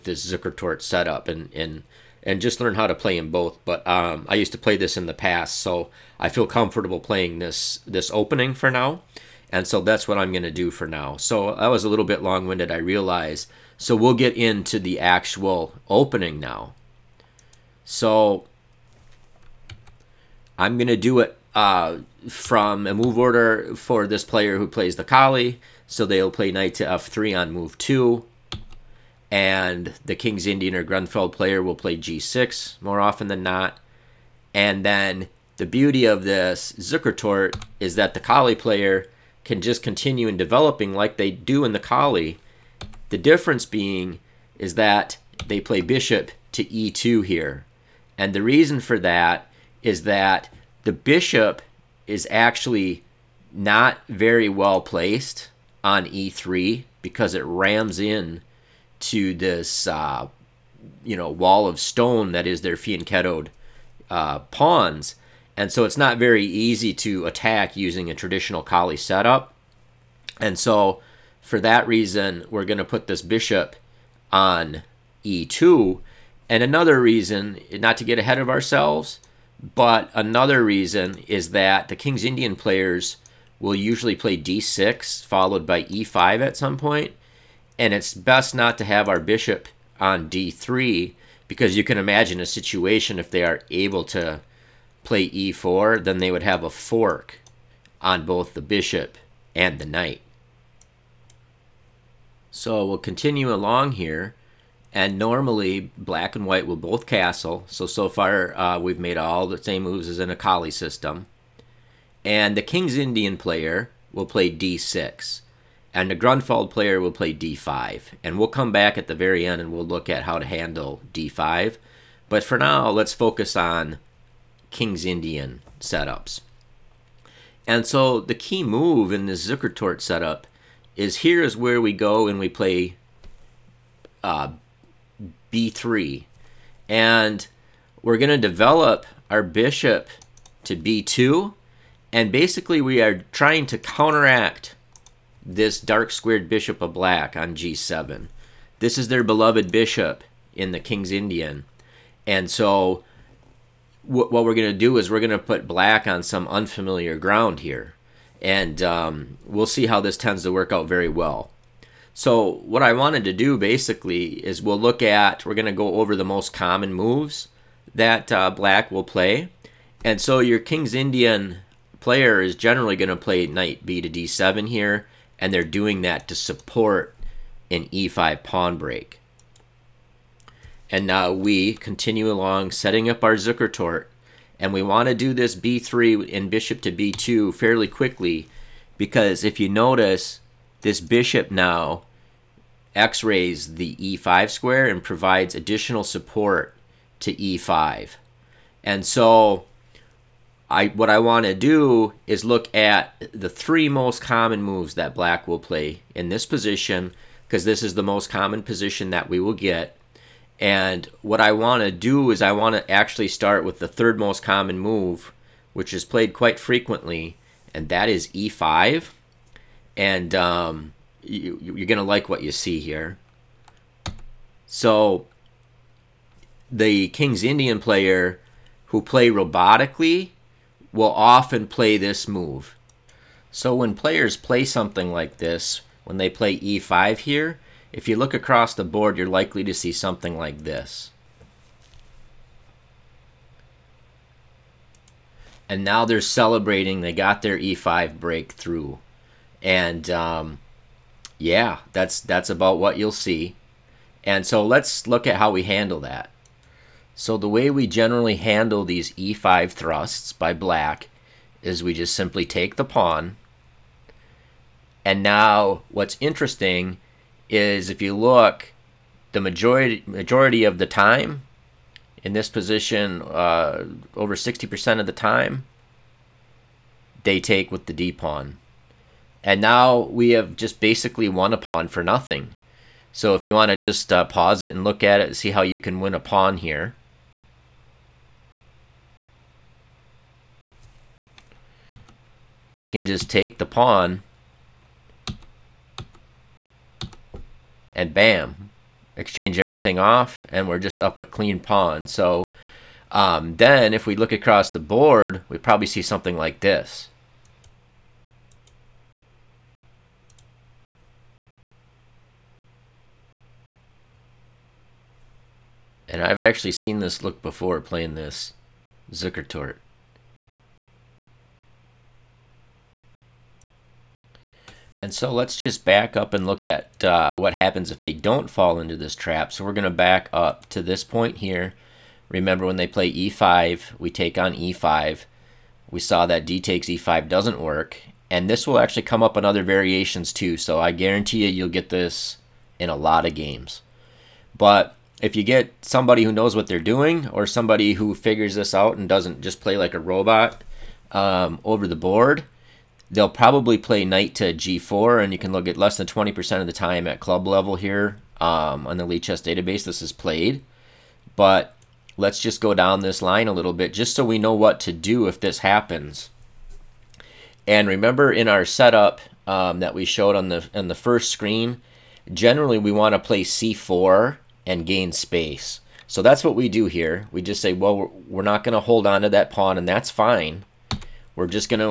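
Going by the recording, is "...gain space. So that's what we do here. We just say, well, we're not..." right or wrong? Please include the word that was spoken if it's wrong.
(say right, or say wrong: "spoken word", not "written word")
right.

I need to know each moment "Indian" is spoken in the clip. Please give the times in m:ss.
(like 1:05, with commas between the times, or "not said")
0:30, 1:22, 1:52, 2:05, 2:31, 2:50, 3:47.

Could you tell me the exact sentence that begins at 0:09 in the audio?
And so that's what I'm going to do for now.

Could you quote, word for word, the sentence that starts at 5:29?
So we're going to back up to this point here.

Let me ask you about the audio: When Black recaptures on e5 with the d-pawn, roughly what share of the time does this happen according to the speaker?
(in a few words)
over 60%.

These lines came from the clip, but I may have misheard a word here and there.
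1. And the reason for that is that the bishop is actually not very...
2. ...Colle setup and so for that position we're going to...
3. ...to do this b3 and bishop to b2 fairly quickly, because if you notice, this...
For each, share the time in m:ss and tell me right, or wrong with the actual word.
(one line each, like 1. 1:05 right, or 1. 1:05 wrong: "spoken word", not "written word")
1. 0:48 right
2. 1:08 wrong: "reason", not "position"
3. 3:05 right.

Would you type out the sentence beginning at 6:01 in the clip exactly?
But let's just go down this line a little bit just so we know what to do if this happens.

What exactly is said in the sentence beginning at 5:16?
And I've actually seen this look before playing this Zukertort.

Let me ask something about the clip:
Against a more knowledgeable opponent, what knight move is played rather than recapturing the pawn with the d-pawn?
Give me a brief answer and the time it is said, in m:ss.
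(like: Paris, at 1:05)
Knight to g4, at 5:54.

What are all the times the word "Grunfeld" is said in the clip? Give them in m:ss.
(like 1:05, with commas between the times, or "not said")
0:30, 1:56.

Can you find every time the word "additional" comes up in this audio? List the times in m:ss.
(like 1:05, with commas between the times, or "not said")
3:15.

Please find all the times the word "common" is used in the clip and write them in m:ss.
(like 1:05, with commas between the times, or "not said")
2:46, 3:24, 3:28, 3:34.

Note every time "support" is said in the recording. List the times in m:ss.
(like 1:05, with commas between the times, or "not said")
2:56, 3:16.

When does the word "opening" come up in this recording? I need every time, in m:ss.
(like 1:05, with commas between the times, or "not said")
0:08, 0:15.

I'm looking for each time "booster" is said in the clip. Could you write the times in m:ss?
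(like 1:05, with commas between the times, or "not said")
not said.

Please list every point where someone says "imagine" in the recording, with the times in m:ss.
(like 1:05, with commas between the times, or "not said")
1:31.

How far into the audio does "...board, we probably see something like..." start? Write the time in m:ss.
5:04.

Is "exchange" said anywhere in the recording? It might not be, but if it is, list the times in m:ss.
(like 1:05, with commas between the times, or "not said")
4:59.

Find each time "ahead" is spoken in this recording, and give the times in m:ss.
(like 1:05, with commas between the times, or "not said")
1:18.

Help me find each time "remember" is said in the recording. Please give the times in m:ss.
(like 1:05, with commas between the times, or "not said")
5:32, 6:07.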